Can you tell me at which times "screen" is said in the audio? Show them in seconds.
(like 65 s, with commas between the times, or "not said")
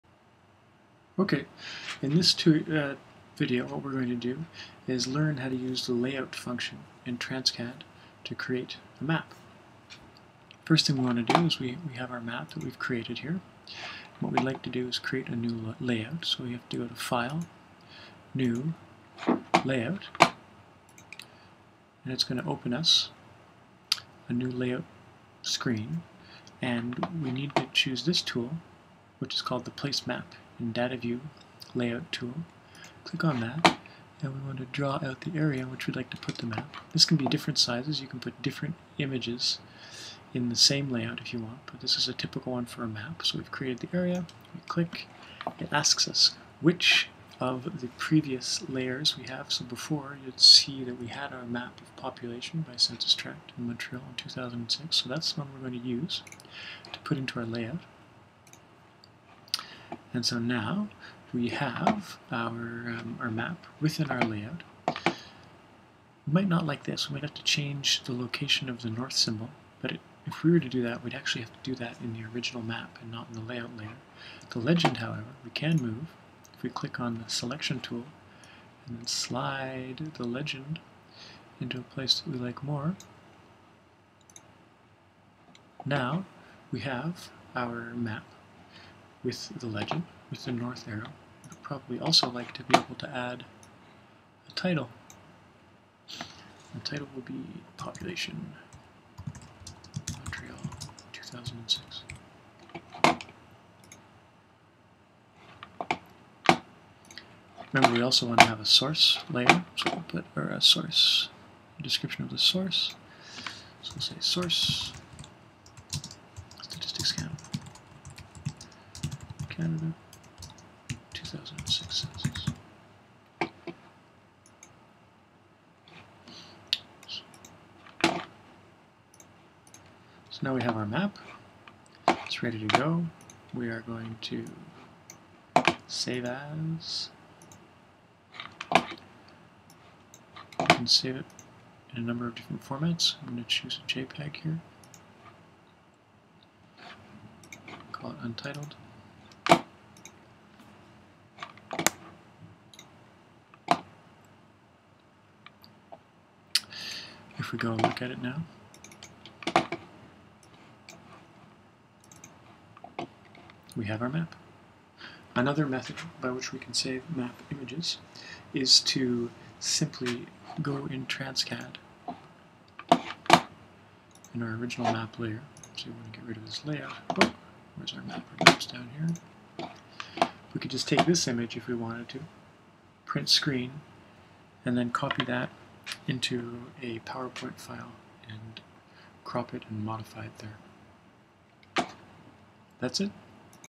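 25 s, 183 s.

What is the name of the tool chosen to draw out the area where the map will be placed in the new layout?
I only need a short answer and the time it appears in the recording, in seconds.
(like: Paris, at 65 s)
Place Map Data View, at 29 s.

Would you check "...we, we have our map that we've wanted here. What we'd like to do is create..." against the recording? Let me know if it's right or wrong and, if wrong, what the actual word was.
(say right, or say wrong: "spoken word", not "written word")
wrong: "created", not "wanted".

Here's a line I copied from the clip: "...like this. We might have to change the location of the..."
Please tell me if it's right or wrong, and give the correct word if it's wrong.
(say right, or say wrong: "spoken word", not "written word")
right.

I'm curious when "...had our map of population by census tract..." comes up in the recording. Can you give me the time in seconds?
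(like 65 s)
51 s.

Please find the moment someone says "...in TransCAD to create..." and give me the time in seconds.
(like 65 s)
7 s.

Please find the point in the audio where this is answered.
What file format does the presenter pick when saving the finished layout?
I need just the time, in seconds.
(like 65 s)
143 s.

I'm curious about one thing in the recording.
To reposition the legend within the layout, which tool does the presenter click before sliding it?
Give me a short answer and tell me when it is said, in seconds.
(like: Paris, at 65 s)
Selection tool, at 77 s.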